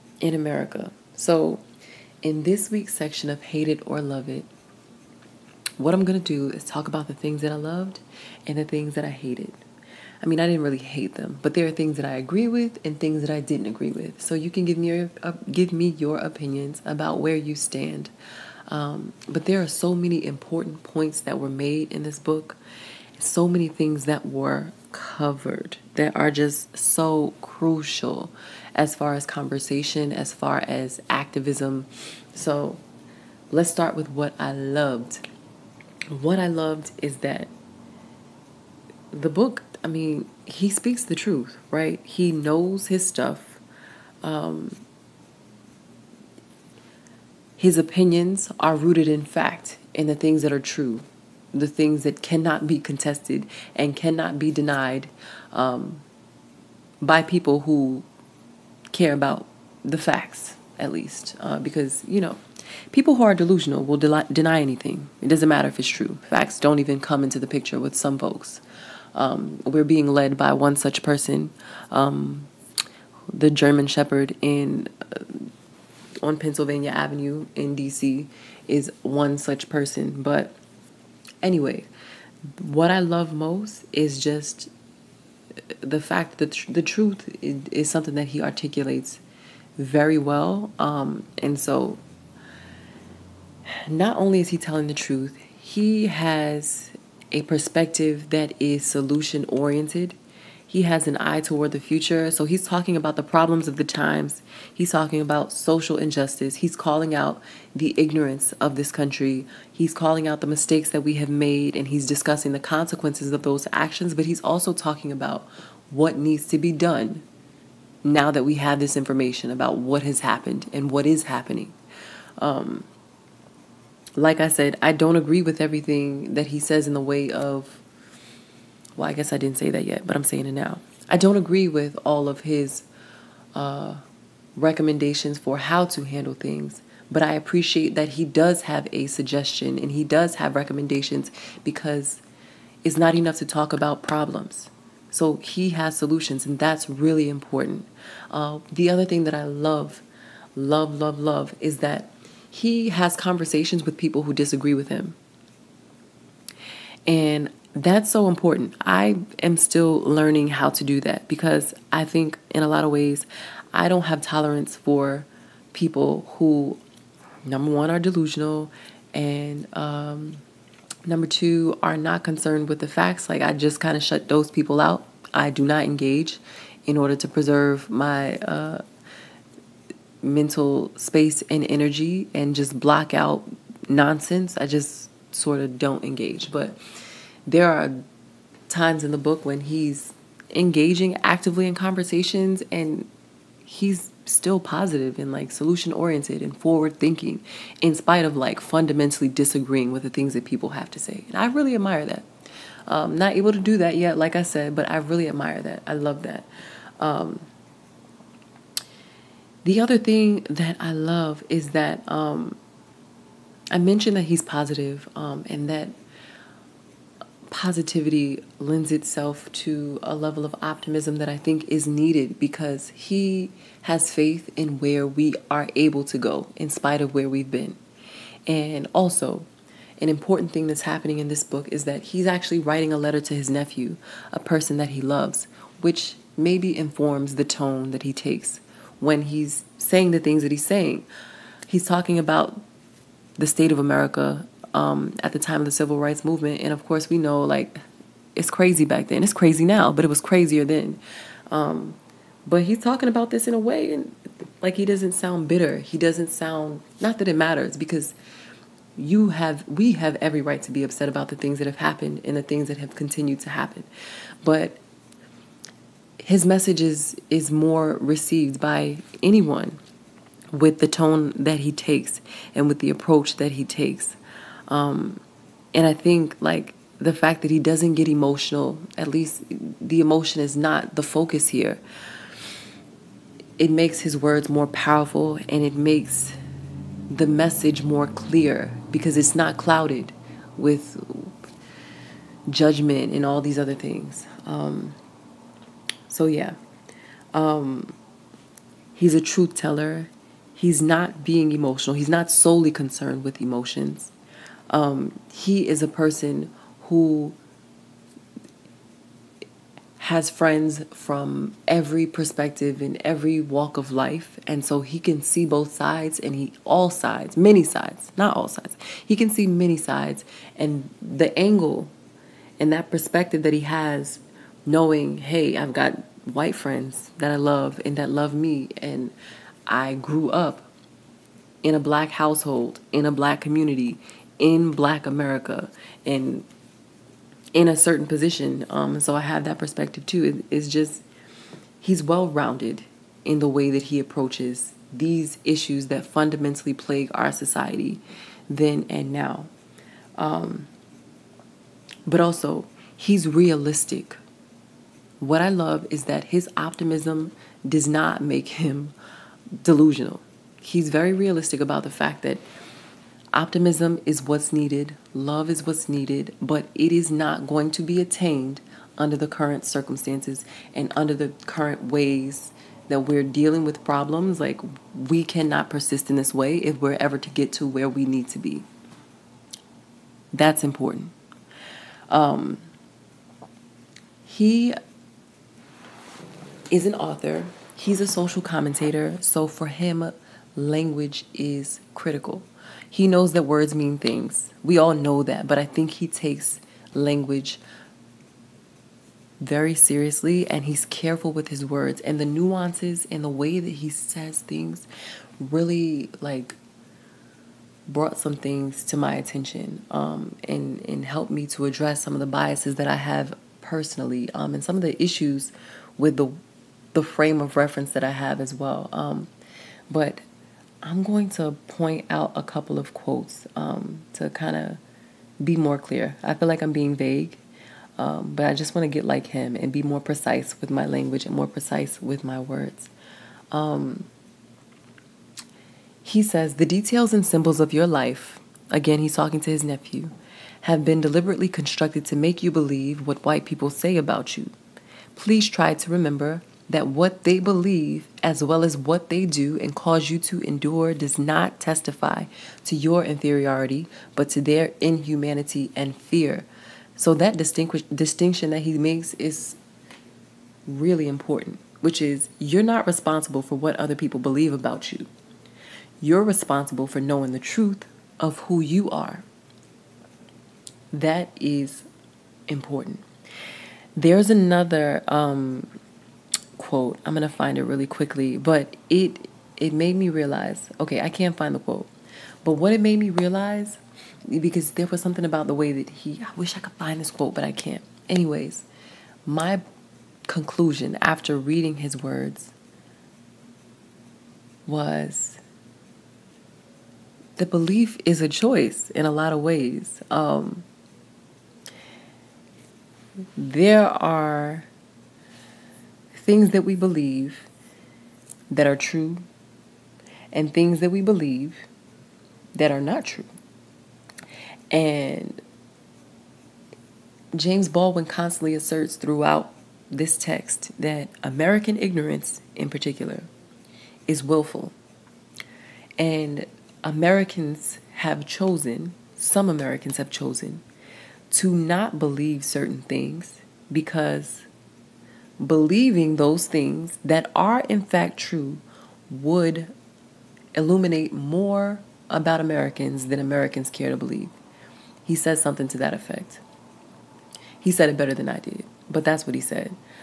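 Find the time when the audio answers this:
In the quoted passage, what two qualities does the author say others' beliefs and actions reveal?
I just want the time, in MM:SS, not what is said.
07:34.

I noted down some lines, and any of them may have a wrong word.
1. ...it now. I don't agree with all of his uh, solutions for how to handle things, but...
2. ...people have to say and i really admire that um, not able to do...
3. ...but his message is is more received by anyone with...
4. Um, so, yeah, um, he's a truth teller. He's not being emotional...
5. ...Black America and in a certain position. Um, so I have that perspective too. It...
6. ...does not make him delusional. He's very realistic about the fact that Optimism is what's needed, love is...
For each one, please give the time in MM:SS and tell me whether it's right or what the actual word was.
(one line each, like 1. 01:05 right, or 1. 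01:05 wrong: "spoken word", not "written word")
1. 02:10 wrong: "recommendations", not "solutions"
2. 03:20 right
3. 04:24 right
4. 04:54 right
5. 05:34 right
6. 05:57 right.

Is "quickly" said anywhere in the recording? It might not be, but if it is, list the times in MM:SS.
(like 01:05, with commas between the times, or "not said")
07:57.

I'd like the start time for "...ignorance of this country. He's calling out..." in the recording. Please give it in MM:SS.
01:47.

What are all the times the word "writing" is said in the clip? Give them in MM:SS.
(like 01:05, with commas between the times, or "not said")
03:52.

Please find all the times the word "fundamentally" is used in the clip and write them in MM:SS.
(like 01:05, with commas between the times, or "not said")
03:18, 05:46.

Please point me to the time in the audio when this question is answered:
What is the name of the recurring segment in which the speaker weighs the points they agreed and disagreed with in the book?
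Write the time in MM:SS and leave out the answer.
00:03.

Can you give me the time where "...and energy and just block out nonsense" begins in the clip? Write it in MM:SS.
03:01.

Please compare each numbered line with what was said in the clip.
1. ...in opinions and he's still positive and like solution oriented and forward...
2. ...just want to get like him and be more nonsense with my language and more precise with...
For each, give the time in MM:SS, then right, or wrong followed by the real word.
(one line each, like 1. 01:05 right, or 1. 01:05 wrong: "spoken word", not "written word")
1. 03:11 wrong: "conversations", not "opinions"
2. 07:08 wrong: "precise", not "nonsense".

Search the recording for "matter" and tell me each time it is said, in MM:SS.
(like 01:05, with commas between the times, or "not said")
01:05, 04:17.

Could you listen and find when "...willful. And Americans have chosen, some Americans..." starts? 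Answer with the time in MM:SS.
08:44.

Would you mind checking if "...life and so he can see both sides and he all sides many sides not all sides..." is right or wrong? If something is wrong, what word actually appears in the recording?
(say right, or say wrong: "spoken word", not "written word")
right.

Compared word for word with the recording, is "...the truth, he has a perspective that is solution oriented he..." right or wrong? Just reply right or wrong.
right.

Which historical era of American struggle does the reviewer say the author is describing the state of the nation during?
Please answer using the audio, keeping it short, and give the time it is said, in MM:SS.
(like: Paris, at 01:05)
The civil rights movement, at 04:05.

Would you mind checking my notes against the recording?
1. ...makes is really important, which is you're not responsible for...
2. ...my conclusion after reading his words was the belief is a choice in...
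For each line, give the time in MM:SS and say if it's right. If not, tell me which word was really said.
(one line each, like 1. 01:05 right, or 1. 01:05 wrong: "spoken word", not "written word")
1. 07:38 right
2. 08:09 right.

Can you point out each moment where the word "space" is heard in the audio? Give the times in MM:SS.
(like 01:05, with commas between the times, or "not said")
03:00.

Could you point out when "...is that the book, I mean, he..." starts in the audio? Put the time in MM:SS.
00:37.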